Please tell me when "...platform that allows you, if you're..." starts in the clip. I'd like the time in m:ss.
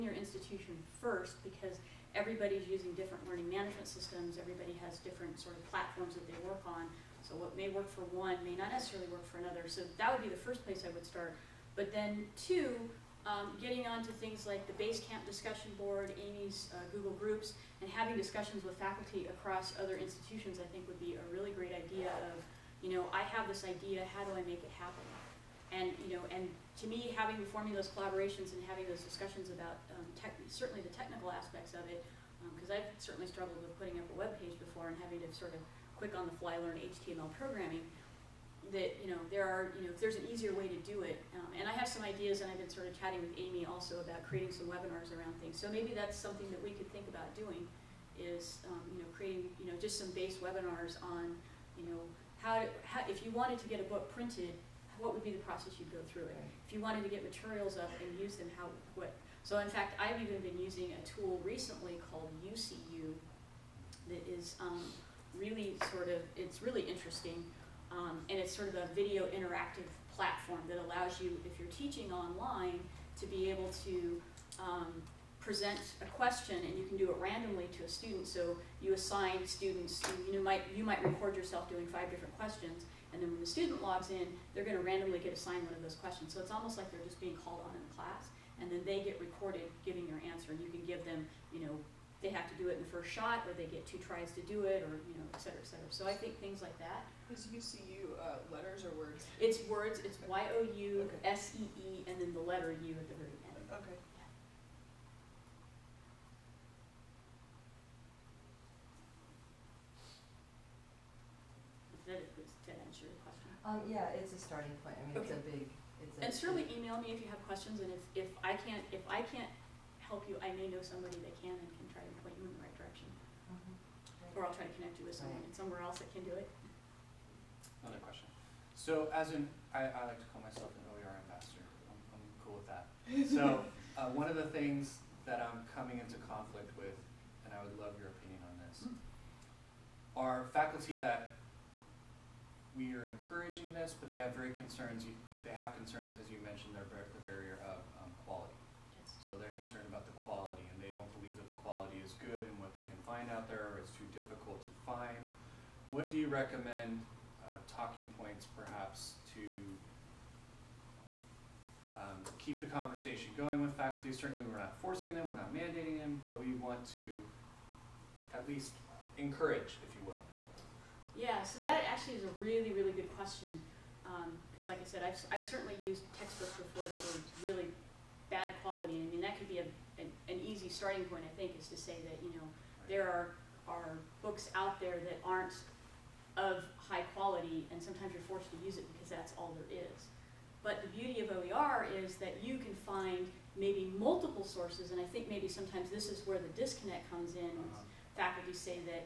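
1:10.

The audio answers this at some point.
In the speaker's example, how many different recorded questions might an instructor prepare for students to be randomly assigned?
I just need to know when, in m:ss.
1:21.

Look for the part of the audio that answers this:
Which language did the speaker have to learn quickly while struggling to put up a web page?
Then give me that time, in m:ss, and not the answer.
0:36.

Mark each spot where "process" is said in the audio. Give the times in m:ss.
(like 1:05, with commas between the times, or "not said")
0:55.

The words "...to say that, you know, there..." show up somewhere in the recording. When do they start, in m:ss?
3:01.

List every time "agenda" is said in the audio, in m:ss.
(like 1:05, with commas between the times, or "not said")
not said.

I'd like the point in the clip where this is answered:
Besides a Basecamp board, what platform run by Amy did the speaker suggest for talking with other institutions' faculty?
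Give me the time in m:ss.
0:16.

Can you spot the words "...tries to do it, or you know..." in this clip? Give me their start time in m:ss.
1:33.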